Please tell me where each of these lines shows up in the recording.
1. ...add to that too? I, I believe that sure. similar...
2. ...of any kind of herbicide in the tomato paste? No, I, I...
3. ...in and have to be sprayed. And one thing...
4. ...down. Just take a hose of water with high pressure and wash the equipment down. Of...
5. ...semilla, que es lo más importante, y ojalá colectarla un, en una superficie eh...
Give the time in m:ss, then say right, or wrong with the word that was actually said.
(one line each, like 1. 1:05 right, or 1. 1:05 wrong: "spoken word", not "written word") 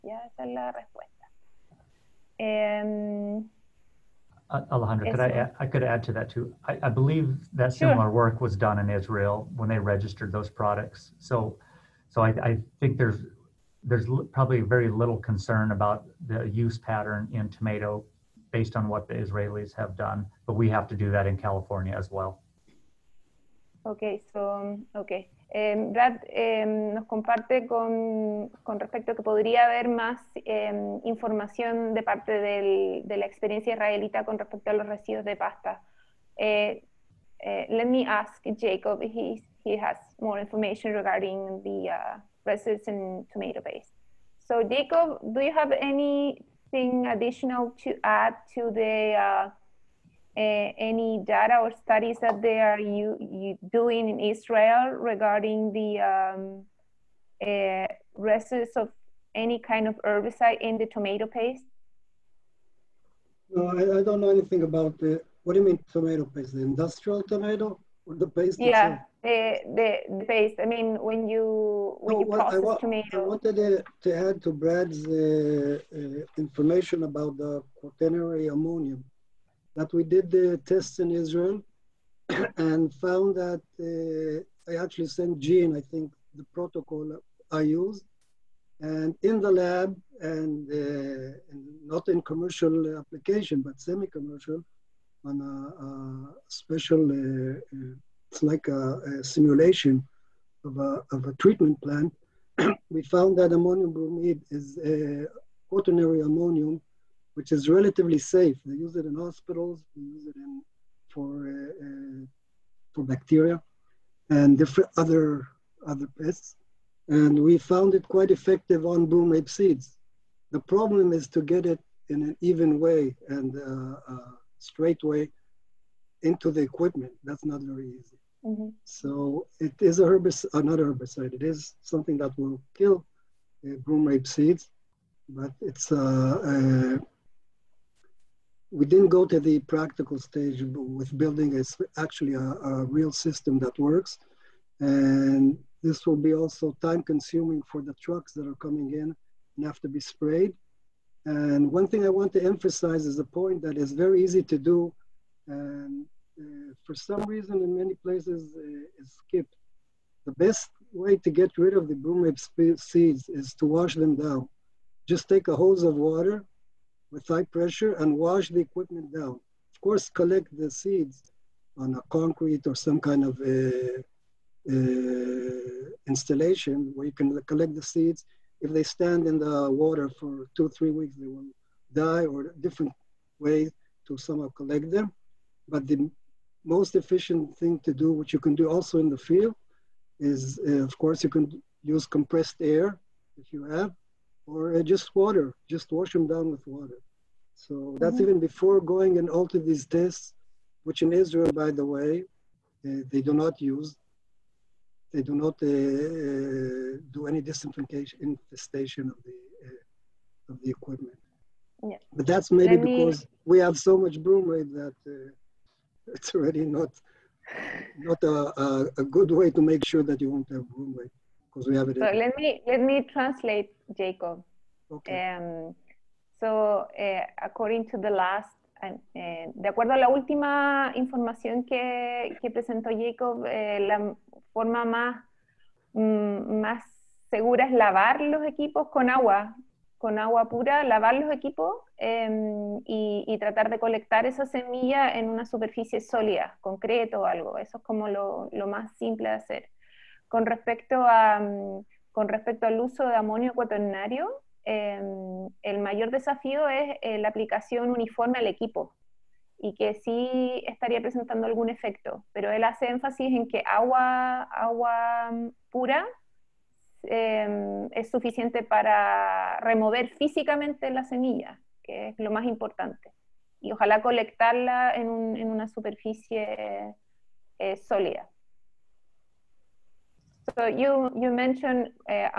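1. 0:05 right
2. 0:58 right
3. 2:28 right
4. 2:44 right
5. 4:31 right.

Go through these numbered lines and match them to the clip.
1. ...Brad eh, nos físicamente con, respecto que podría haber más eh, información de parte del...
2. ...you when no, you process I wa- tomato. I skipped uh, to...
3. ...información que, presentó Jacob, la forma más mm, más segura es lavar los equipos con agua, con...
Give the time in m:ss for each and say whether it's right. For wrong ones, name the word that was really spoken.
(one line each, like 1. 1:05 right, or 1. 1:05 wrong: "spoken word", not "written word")
1. 0:25 wrong: "comparte", not "físicamente"
2. 1:11 wrong: "wanted", not "skipped"
3. 3:50 right.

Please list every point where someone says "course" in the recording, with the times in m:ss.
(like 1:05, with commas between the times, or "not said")
2:49, 3:10.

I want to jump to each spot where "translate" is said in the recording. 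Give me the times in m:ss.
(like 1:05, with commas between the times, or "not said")
3:43.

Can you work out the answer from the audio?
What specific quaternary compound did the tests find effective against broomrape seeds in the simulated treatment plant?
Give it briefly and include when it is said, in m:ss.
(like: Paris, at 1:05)
ammonium bromide, at 1:43.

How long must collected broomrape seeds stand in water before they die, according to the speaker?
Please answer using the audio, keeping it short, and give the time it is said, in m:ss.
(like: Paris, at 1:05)
2 to 3 weeks, at 3:00.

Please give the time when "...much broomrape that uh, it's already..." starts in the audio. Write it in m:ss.
3:33.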